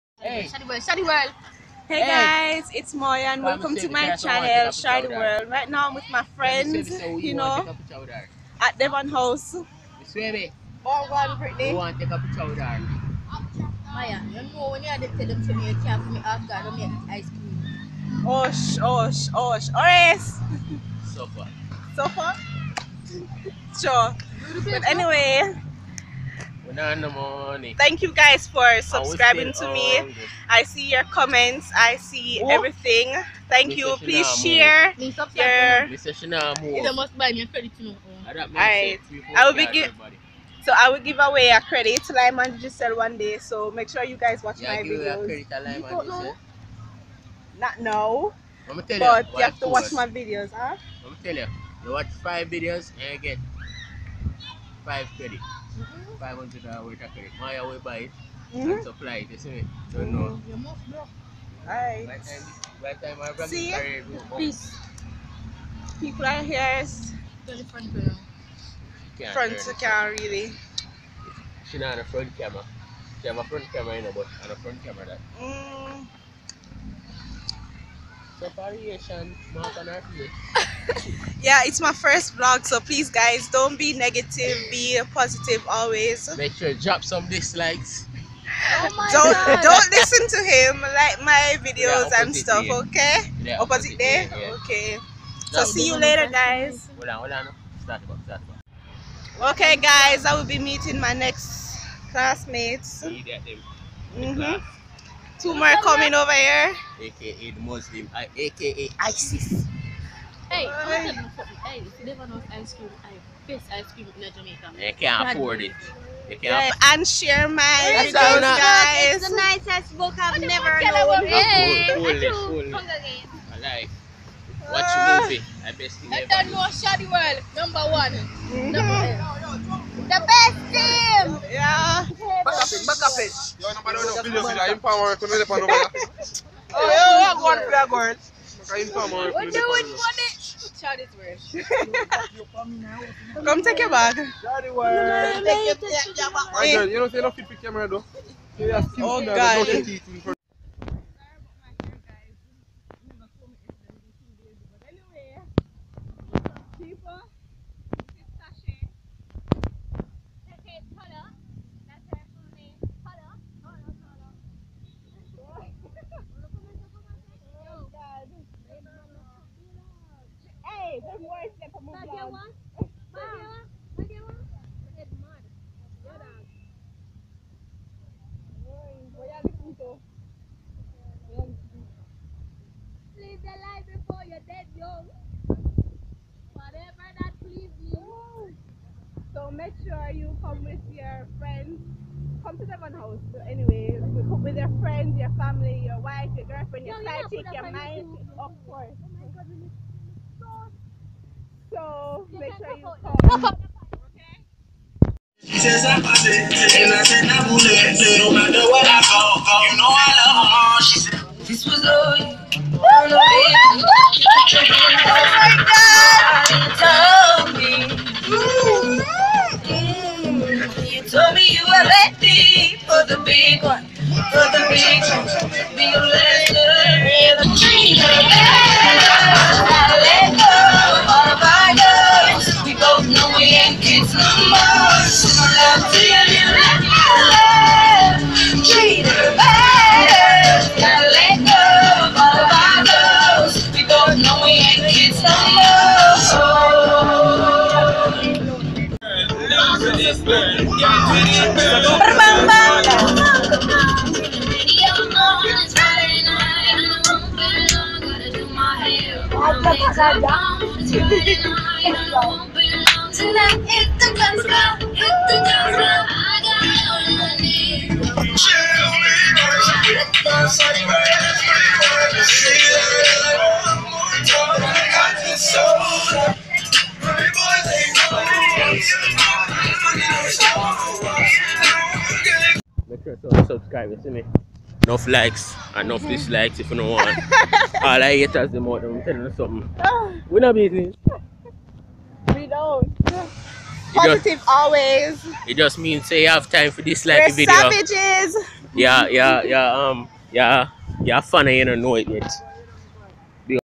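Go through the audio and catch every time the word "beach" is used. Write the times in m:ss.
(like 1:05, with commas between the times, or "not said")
not said.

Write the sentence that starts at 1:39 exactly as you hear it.
Okay guys, I will be meeting my next classmates.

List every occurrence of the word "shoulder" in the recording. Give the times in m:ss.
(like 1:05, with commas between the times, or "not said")
not said.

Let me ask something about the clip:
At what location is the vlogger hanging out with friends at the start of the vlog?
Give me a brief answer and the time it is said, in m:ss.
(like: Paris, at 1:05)
Devon House, at 0:08.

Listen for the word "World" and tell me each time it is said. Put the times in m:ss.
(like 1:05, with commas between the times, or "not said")
0:01, 0:05, 2:07.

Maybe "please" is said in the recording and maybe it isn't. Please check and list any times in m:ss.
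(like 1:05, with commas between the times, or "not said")
0:33, 1:04, 1:22.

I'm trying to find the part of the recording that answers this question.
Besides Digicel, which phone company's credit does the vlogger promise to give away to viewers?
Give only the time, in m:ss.
0:42.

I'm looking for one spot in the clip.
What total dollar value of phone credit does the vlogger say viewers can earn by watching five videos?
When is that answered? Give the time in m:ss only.
0:56.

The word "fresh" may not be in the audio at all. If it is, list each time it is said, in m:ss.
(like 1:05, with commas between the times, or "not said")
not said.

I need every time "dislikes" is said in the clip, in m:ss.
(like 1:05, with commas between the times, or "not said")
1:27, 4:46, 4:56.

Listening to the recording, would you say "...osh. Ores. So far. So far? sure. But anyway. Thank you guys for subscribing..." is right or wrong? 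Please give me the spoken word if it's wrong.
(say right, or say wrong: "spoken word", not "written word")
right.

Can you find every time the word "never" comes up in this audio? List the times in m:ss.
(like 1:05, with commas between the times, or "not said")
1:52, 2:00.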